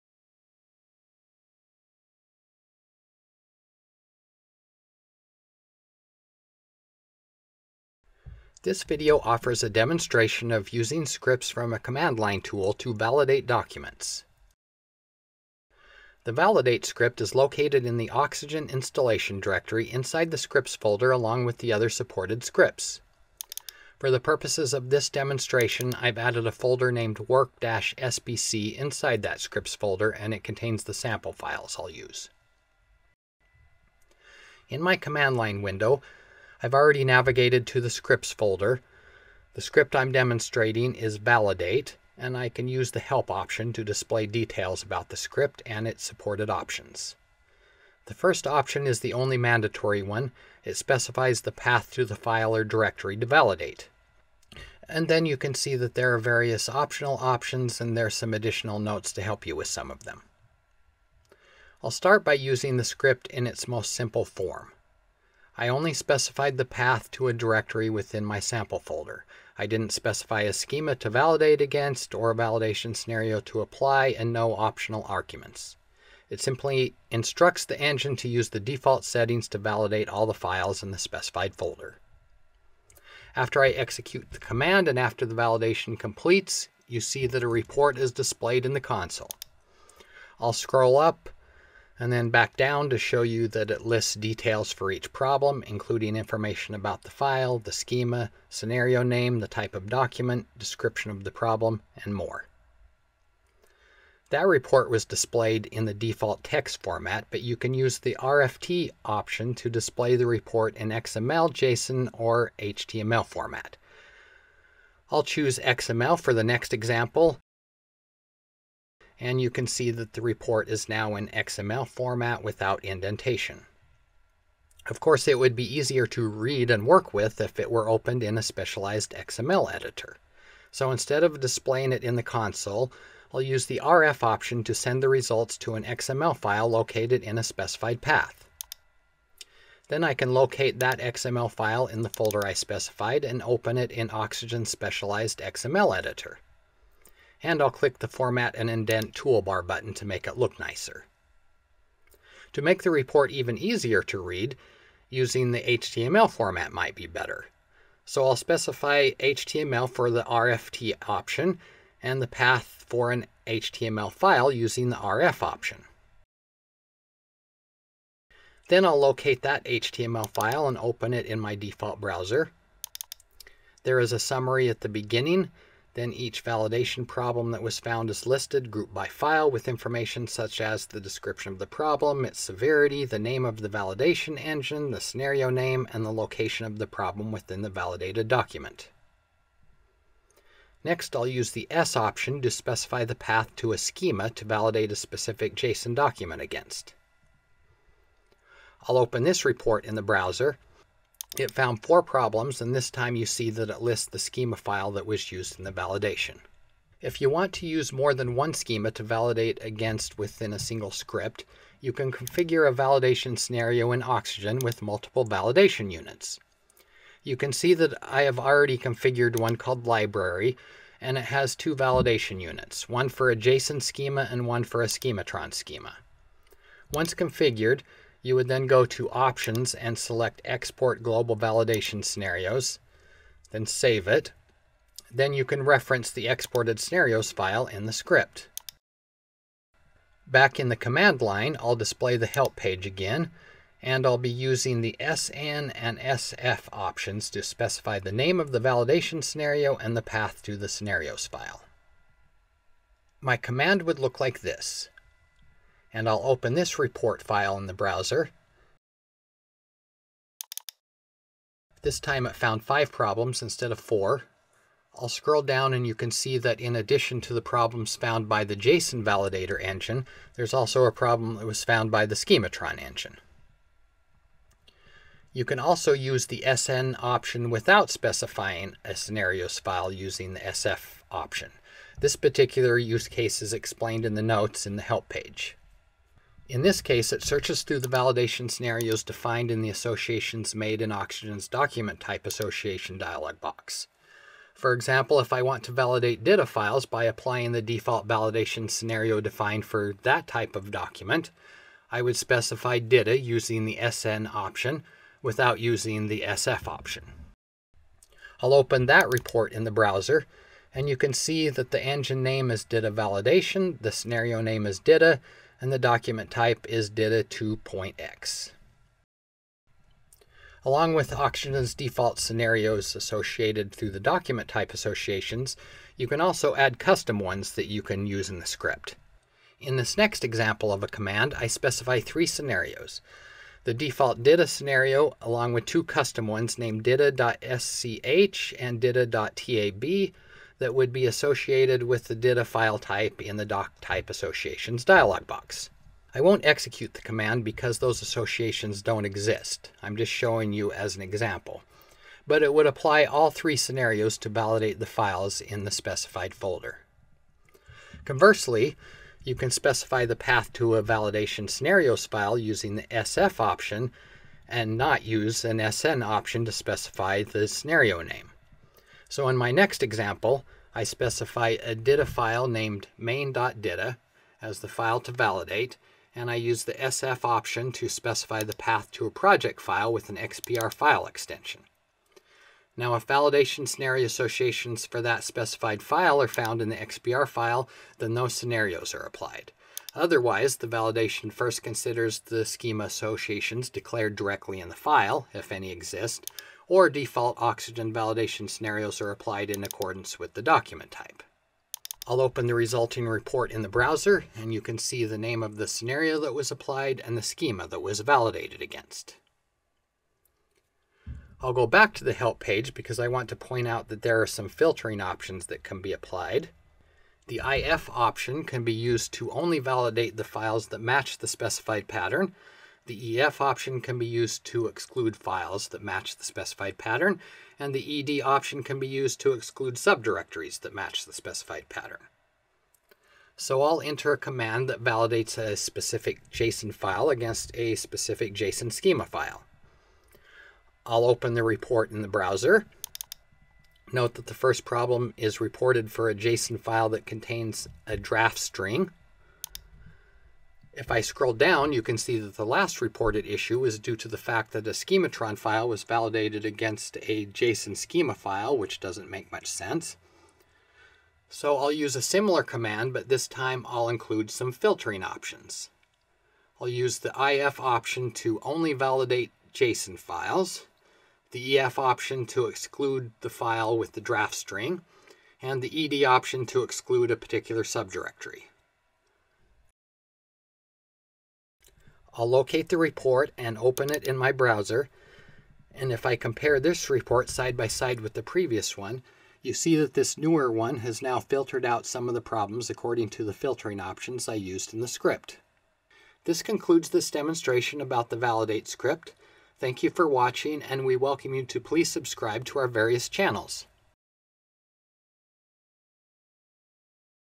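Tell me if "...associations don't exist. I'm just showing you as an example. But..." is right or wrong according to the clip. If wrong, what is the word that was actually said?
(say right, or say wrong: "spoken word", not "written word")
right.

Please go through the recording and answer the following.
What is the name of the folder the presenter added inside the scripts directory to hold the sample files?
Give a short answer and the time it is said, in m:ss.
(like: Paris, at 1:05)
work-sbc, at 0:27.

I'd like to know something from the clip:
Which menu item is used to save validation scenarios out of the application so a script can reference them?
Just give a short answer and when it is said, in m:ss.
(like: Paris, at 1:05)
Export Global Validation Scenarios, at 3:50.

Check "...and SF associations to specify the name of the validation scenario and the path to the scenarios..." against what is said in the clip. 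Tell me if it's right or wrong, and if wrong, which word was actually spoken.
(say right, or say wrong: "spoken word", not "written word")
wrong: "options", not "associations".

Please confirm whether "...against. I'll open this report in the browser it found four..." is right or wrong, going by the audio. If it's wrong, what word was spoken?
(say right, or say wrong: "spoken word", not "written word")
right.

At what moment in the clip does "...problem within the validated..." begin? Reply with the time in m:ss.
3:06.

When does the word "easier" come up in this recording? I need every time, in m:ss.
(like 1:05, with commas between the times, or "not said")
2:05, 2:33.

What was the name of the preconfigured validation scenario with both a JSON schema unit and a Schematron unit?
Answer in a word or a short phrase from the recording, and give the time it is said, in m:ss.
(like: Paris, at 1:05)
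Library, at 3:39.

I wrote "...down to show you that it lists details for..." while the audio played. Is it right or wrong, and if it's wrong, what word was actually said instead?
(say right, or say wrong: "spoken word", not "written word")
right.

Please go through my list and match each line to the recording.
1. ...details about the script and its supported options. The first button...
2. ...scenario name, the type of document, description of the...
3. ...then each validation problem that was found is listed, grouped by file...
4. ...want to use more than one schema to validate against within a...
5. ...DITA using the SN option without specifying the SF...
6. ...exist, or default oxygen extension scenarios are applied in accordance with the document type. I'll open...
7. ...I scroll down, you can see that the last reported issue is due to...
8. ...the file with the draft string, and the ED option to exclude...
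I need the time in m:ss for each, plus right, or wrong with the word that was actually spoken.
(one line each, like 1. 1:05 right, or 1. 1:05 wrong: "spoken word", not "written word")
1. 0:44 wrong: "option", not "button"
2. 1:38 right
3. 2:55 right
4. 3:27 right
5. 5:02 wrong: "using", not "specifying"
6. 6:35 wrong: "validation", not "extension"
7. 7:30 right
8. 7:53 right.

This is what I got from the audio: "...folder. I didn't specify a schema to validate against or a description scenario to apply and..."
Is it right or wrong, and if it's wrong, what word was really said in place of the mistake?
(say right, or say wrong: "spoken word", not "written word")
wrong: "validation", not "description".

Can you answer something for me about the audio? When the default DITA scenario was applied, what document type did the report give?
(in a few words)
DITA 2.x.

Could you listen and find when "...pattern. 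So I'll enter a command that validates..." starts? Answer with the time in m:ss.
7:11.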